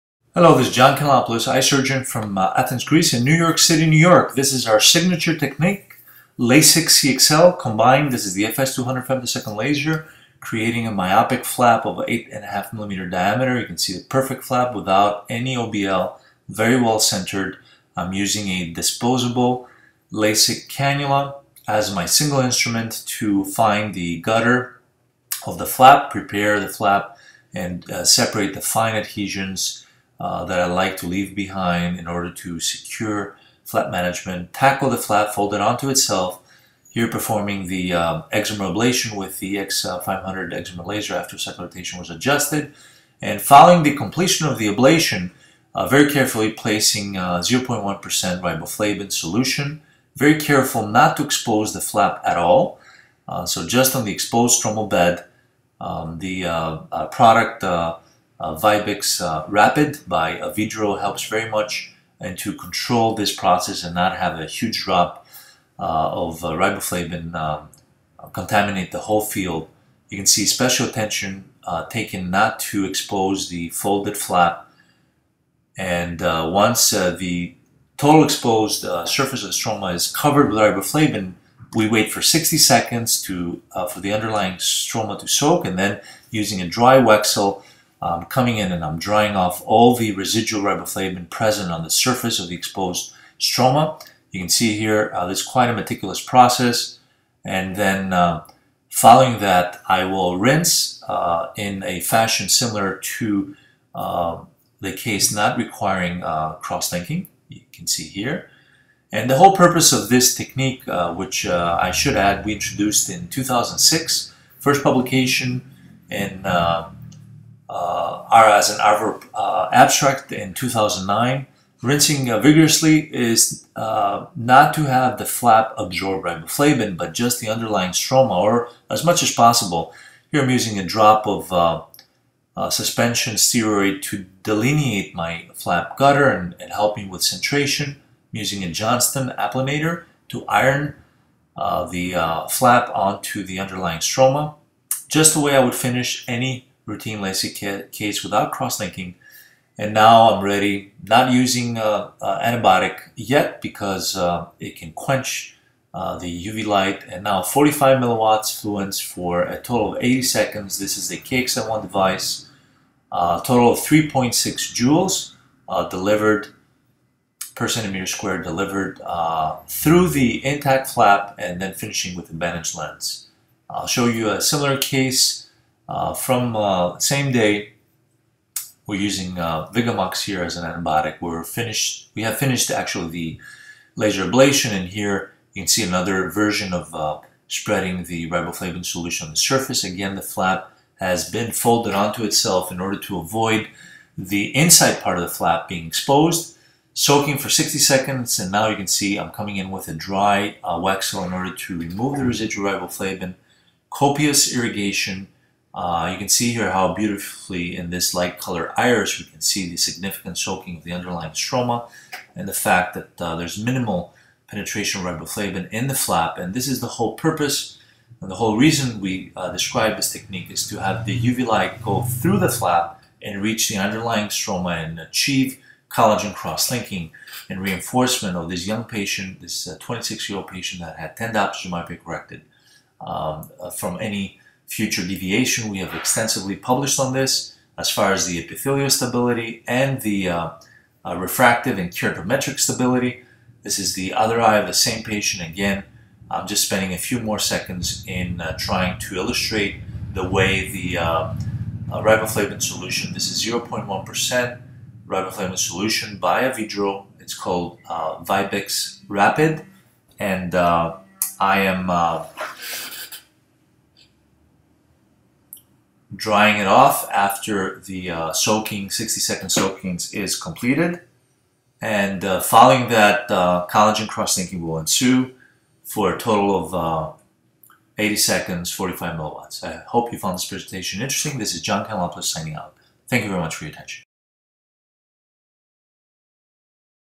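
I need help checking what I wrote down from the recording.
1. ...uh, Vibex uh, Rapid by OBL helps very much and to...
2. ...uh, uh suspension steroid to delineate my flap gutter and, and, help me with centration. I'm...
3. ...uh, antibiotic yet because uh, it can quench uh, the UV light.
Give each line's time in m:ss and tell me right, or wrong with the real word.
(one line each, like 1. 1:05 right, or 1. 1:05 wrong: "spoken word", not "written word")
1. 0:58 wrong: "Avedro", not "OBL"
2. 2:11 right
3. 2:32 right.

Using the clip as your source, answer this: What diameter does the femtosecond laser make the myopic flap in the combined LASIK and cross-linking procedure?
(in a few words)
8.5 millimeters.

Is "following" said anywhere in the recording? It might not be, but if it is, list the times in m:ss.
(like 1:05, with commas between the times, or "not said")
0:43, 1:38, 4:32.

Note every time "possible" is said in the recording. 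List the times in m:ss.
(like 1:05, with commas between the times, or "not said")
2:09.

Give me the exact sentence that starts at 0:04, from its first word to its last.
This is our signature technique, LASIK CXL combined.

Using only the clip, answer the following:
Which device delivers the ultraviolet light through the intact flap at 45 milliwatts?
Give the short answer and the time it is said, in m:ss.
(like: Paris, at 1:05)
KXM1, at 2:41.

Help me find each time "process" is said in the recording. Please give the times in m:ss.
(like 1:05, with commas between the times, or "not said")
1:03, 1:36.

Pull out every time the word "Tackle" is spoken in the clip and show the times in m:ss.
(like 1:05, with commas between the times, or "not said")
0:34.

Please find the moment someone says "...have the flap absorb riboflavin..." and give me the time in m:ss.
2:04.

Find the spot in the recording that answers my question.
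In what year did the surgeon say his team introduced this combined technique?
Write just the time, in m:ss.
1:53.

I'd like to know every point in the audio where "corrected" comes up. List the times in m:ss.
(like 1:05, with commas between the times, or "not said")
3:51.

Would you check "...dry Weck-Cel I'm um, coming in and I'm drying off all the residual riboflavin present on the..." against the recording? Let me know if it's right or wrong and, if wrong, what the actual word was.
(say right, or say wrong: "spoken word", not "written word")
right.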